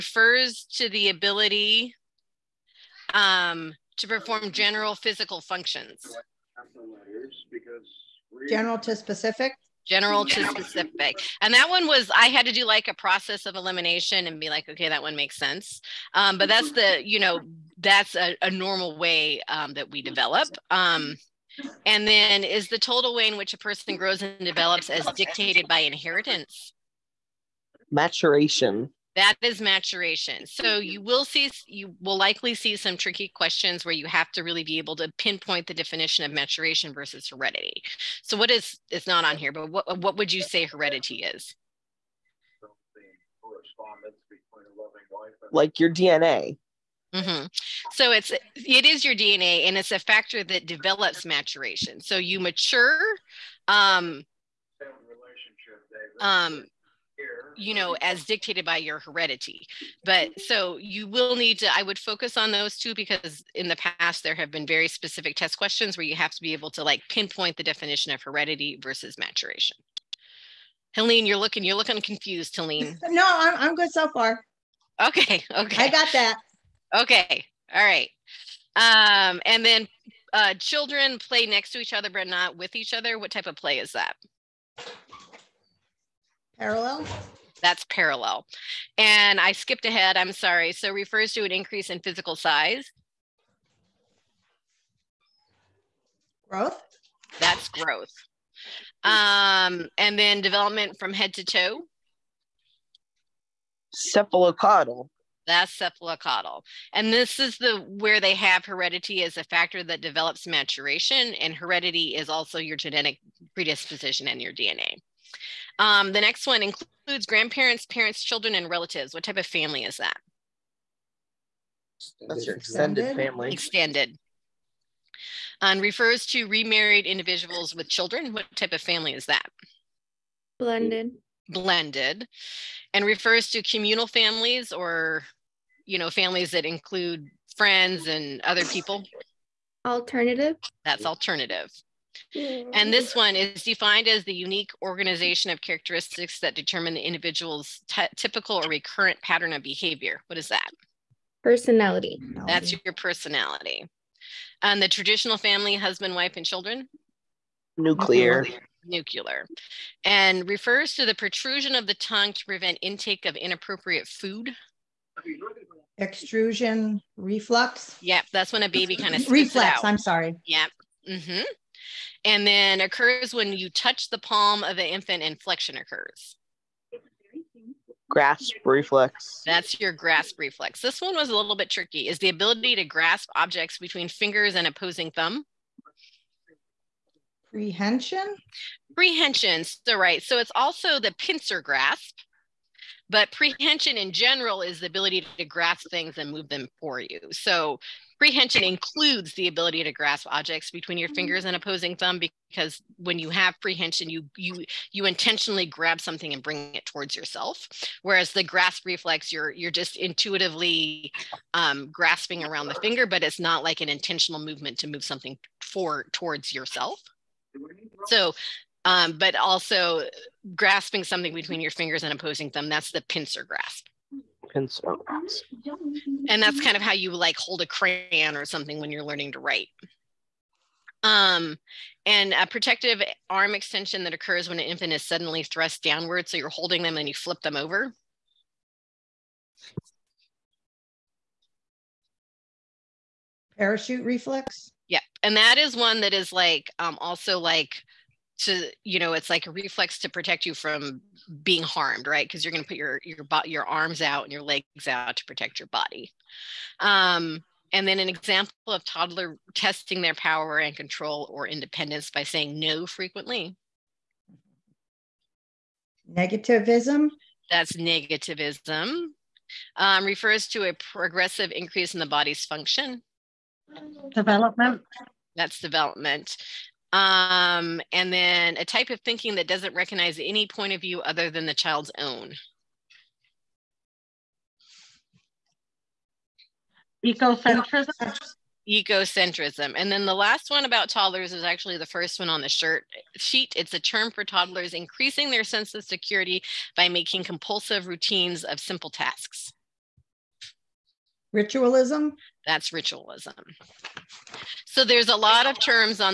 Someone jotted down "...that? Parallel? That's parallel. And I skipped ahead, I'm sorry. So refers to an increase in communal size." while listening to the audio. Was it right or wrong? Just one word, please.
wrong.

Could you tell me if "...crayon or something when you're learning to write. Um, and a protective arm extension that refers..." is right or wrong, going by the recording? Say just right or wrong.
wrong.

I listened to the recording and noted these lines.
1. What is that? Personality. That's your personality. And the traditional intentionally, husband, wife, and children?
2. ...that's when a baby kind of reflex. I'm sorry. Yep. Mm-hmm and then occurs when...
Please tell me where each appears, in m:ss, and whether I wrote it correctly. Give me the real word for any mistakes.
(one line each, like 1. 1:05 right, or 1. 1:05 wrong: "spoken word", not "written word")
1. 2:30 wrong: "family", not "intentionally"
2. 2:48 right.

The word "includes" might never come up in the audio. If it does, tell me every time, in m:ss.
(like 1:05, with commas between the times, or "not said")
1:56, 2:16, 3:18.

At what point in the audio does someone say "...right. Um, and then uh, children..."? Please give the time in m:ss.
1:17.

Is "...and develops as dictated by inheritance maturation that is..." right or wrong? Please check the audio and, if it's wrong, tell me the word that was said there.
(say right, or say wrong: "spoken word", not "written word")
right.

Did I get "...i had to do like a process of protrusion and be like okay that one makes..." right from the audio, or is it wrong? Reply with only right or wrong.
wrong.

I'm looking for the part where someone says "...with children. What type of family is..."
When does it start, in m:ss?
2:07.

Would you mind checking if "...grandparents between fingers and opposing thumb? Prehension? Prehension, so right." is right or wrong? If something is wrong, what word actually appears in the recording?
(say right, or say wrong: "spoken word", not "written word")
wrong: "objects", not "grandparents".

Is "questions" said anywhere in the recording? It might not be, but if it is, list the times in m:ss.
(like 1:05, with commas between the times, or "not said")
0:33, 1:05.